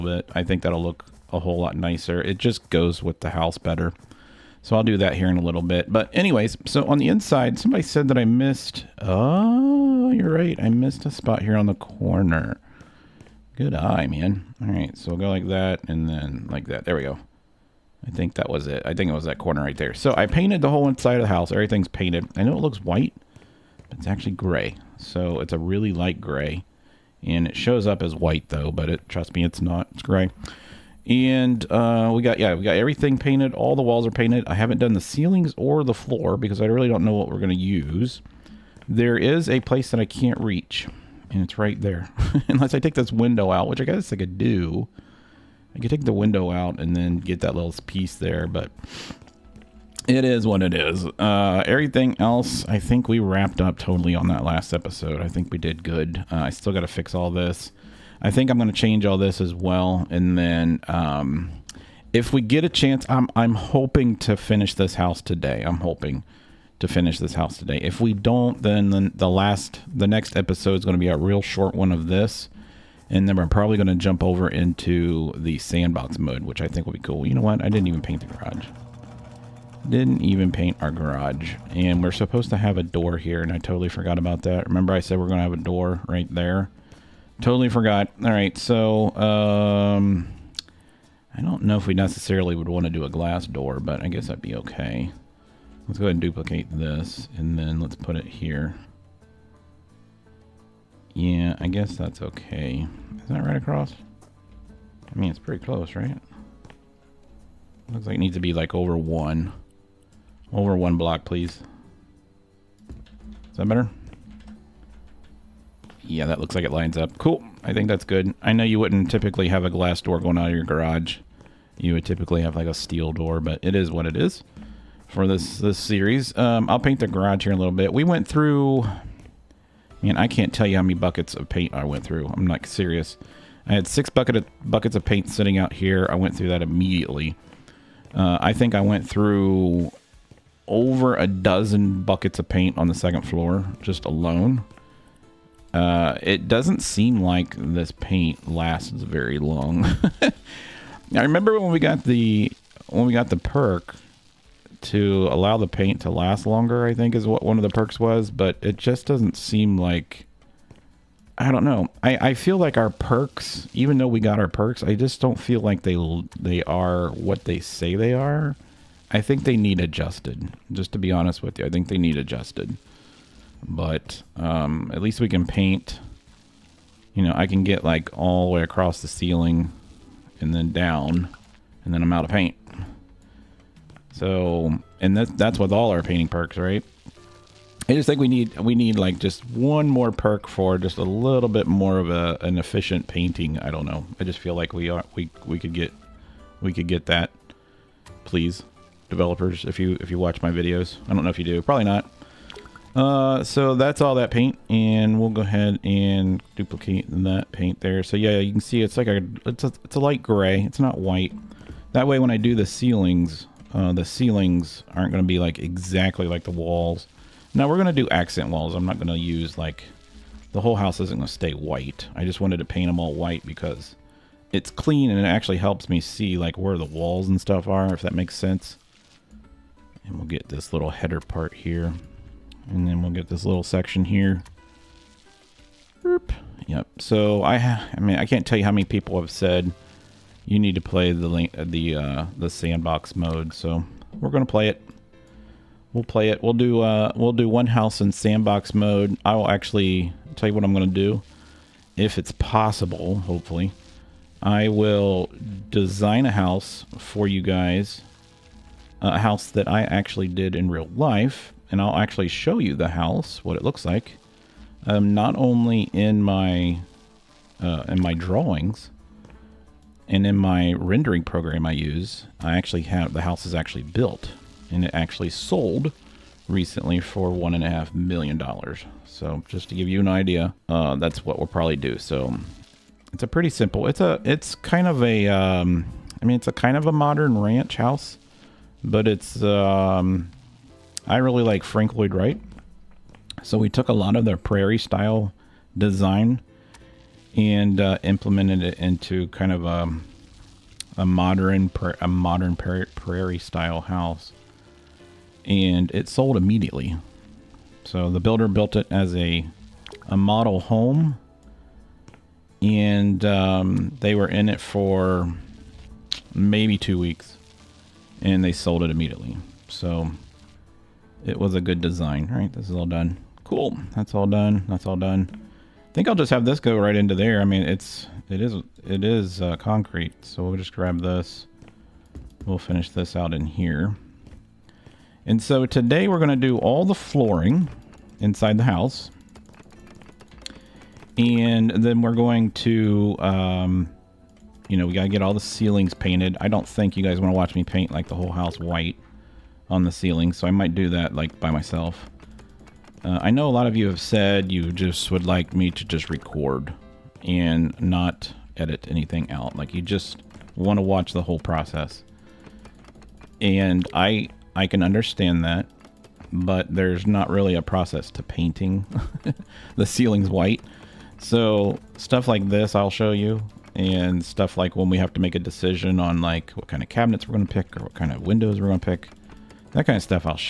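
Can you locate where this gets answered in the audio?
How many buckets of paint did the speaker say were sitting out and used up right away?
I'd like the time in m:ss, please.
2:13.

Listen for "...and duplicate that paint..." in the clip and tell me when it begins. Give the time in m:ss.
3:25.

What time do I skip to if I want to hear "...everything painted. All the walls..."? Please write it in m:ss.
0:32.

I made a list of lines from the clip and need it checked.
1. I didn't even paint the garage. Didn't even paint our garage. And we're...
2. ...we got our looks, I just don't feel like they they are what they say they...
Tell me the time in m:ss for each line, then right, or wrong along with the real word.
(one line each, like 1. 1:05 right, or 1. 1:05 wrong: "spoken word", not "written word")
1. 1:17 right
2. 2:44 wrong: "perks", not "looks".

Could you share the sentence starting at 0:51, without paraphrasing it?
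Uh, everything else, I think we wrapped up totally on that last episode.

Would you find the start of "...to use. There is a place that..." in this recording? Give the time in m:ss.
0:37.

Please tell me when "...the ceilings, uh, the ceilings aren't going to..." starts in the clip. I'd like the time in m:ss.
3:32.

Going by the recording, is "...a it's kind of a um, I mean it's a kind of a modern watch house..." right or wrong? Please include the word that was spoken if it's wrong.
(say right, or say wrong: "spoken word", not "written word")
wrong: "ranch", not "watch".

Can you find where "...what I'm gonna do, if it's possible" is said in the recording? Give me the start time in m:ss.
4:10.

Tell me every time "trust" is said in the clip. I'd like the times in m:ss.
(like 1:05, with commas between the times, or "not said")
0:29.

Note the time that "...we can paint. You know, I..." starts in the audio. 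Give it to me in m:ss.
2:55.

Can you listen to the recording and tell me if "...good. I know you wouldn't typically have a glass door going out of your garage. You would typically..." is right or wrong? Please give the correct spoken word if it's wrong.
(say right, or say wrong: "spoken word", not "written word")
right.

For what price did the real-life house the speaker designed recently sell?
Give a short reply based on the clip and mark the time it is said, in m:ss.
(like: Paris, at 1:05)
$1.5 million, at 4:37.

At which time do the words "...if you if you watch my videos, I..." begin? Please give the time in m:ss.
3:19.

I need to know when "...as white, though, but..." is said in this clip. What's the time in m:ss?
0:28.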